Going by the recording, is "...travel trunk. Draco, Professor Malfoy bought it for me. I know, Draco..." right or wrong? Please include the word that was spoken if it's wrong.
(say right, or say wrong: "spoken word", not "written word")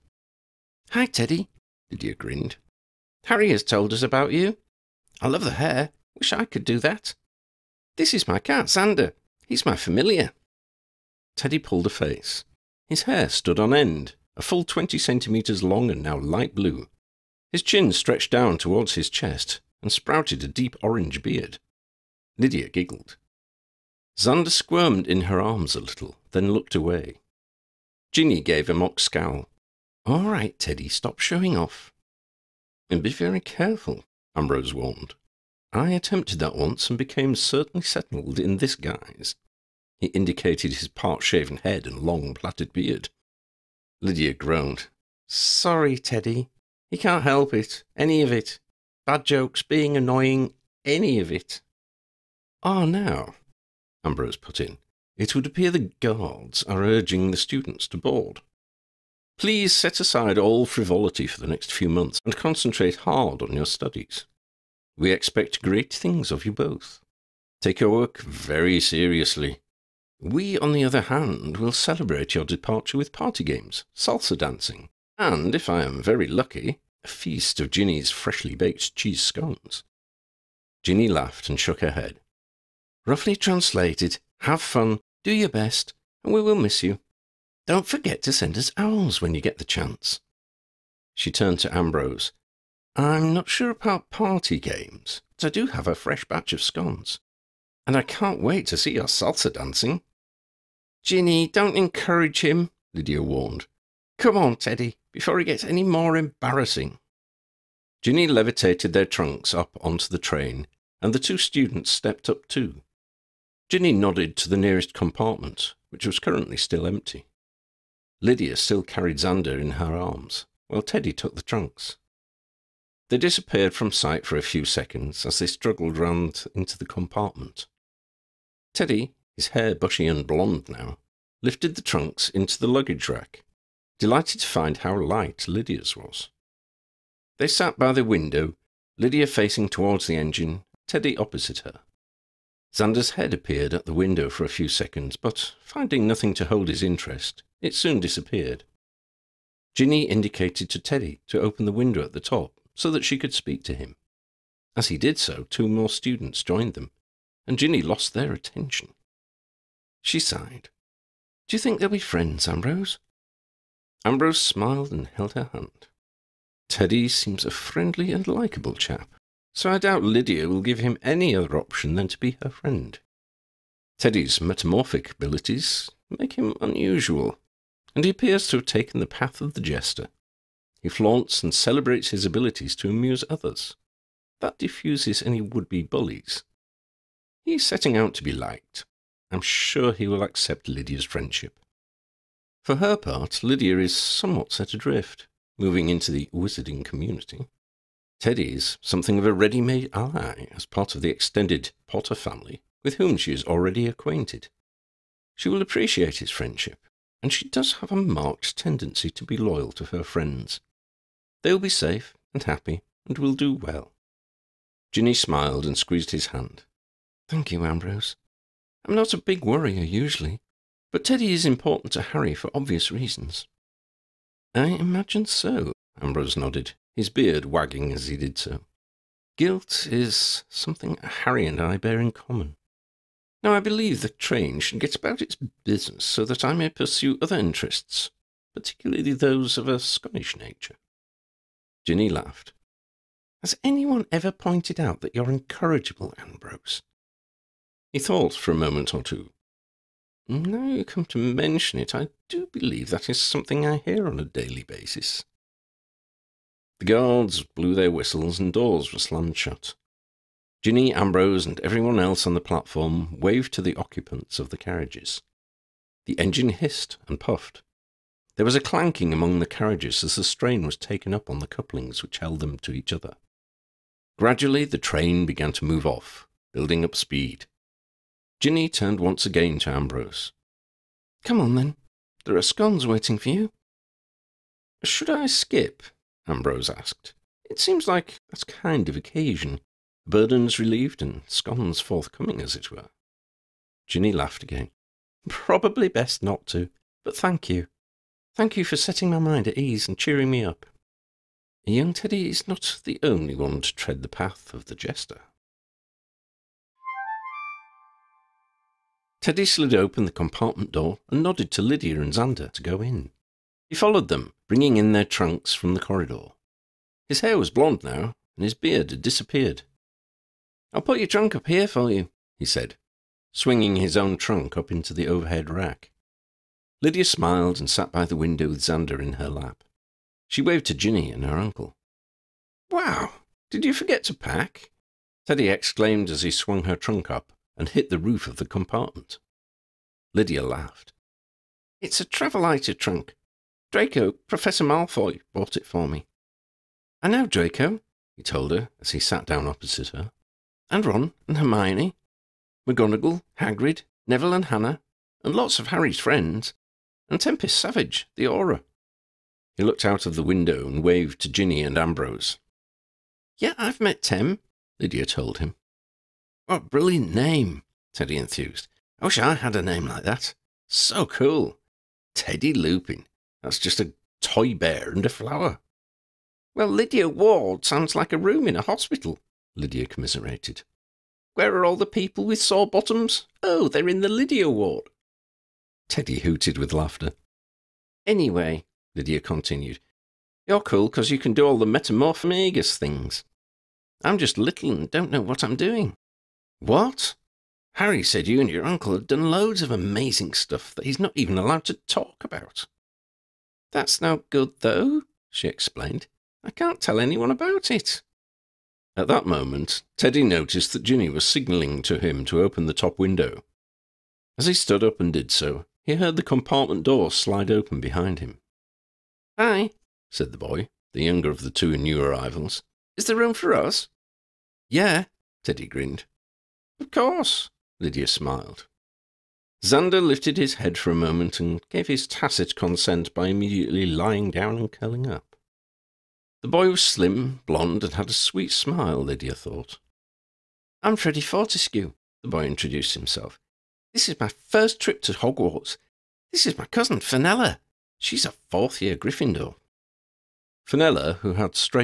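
right.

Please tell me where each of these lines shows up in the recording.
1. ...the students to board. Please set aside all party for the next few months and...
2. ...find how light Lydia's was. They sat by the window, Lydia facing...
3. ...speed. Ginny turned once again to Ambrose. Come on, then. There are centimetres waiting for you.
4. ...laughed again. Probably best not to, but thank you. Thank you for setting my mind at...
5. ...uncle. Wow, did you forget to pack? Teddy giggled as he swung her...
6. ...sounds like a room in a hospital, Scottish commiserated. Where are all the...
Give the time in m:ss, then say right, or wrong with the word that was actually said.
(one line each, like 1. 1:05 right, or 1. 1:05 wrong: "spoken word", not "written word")
1. 0:57 wrong: "frivolity", not "party"
2. 2:14 right
3. 4:36 wrong: "scones", not "centimetres"
4. 4:54 right
5. 5:31 wrong: "exclaimed", not "giggled"
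6. 6:17 wrong: "Lydia", not "Scottish".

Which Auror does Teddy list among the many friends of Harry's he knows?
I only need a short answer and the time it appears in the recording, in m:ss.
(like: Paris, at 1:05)
Tempest Savage, at 5:57.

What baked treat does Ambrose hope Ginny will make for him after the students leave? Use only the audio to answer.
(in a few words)
Cheese scones.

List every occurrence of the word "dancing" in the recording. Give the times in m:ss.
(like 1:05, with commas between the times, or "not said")
1:14, 1:39.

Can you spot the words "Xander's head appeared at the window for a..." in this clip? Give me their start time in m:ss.
2:22.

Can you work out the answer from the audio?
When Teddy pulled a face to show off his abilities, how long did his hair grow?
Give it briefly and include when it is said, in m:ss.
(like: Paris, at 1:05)
20 centimetres, at 0:14.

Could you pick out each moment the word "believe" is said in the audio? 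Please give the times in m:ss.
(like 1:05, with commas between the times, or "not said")
3:53, 4:12.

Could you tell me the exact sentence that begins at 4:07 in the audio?
He thought for a moment or two.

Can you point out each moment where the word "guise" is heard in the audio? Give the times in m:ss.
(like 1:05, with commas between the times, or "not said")
0:38.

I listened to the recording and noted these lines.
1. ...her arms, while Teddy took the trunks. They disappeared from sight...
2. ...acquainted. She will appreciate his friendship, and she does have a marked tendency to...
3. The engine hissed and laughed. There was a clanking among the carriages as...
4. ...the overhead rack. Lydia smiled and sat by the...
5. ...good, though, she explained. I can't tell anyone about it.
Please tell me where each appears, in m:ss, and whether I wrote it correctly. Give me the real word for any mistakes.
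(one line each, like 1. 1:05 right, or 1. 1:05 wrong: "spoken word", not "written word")
1. 1:59 right
2. 3:23 right
3. 4:26 wrong: "puffed", not "laughed"
4. 5:24 right
5. 6:44 right.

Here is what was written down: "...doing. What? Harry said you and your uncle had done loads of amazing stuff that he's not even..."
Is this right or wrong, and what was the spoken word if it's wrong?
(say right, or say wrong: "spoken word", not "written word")
right.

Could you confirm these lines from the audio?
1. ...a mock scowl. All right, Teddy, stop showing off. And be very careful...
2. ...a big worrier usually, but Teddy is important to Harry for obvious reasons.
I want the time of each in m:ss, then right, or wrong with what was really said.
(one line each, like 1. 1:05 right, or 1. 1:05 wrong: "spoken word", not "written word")
1. 0:28 right
2. 3:39 right.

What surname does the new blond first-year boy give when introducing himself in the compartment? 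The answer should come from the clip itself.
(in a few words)
Fortescue.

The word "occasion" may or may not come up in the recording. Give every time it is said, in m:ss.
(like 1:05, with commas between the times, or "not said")
4:48.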